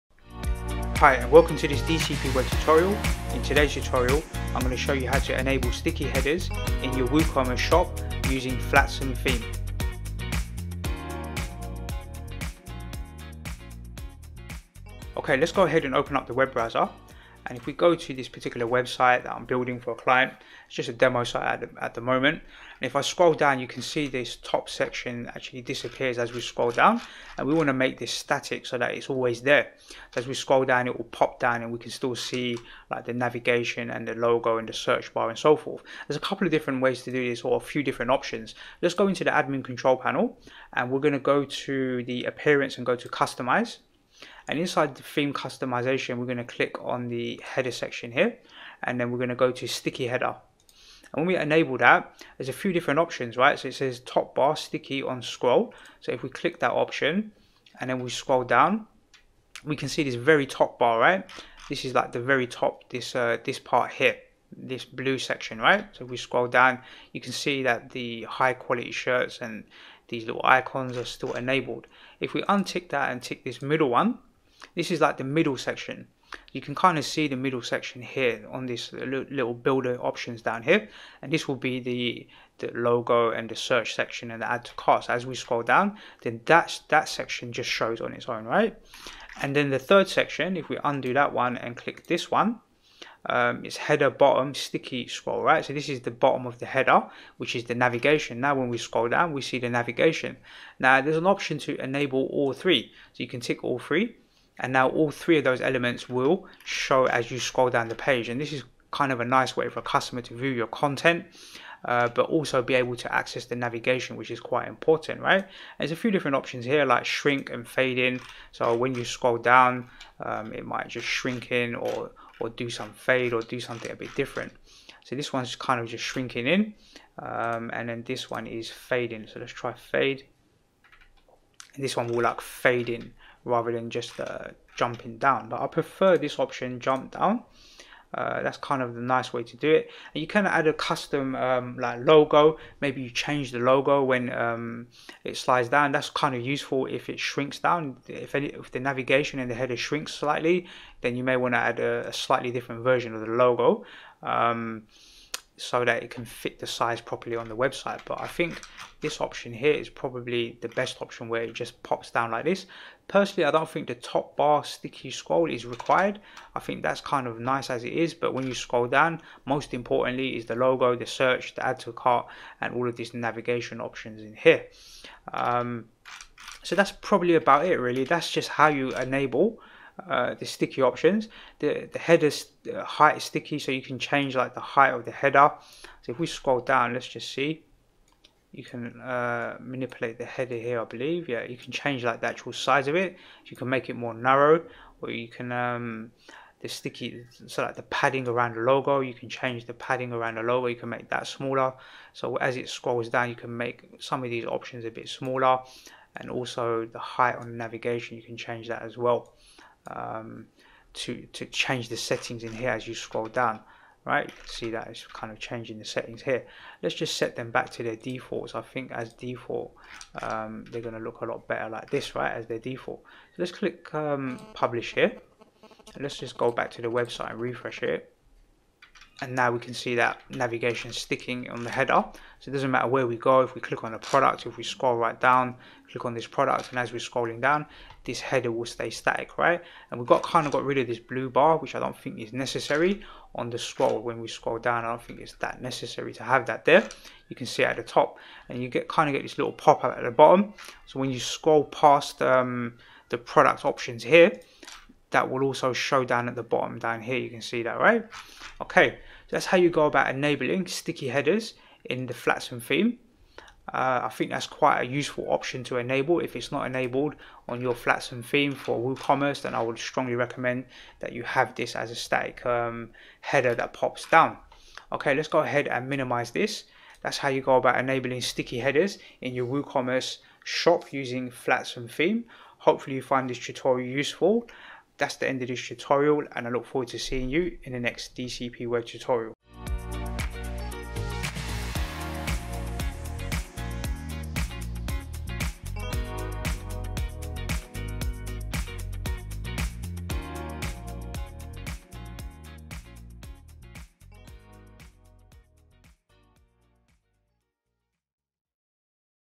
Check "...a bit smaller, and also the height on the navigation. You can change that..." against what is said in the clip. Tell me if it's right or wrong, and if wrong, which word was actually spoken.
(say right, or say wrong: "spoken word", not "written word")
right.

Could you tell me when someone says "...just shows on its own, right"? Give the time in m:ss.
1:27.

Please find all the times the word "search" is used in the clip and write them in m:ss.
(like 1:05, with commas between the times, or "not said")
0:34, 1:23, 2:51.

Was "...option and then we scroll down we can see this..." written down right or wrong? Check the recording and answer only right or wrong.
right.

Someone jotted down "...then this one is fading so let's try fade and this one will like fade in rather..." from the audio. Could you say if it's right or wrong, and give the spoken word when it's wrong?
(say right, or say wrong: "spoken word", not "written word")
right.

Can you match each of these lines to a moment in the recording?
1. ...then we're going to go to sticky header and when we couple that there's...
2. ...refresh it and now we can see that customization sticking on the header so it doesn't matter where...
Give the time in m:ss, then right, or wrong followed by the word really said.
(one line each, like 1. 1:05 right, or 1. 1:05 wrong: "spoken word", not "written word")
1. 0:48 wrong: "enable", not "couple"
2. 3:47 wrong: "navigation", not "customization".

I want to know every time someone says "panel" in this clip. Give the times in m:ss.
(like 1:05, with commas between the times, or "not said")
0:39.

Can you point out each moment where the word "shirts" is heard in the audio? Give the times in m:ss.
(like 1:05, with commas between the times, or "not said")
1:08.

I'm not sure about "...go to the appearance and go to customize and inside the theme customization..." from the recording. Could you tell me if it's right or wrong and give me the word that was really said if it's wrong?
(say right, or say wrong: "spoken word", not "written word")
right.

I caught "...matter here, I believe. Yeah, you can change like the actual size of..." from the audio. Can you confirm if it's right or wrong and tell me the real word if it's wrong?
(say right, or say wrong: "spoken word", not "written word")
wrong: "header", not "matter".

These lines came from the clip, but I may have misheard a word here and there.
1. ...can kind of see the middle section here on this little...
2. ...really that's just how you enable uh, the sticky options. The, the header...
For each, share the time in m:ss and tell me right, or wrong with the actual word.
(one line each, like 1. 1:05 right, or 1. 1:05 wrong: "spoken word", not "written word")
1. 1:16 right
2. 2:57 right.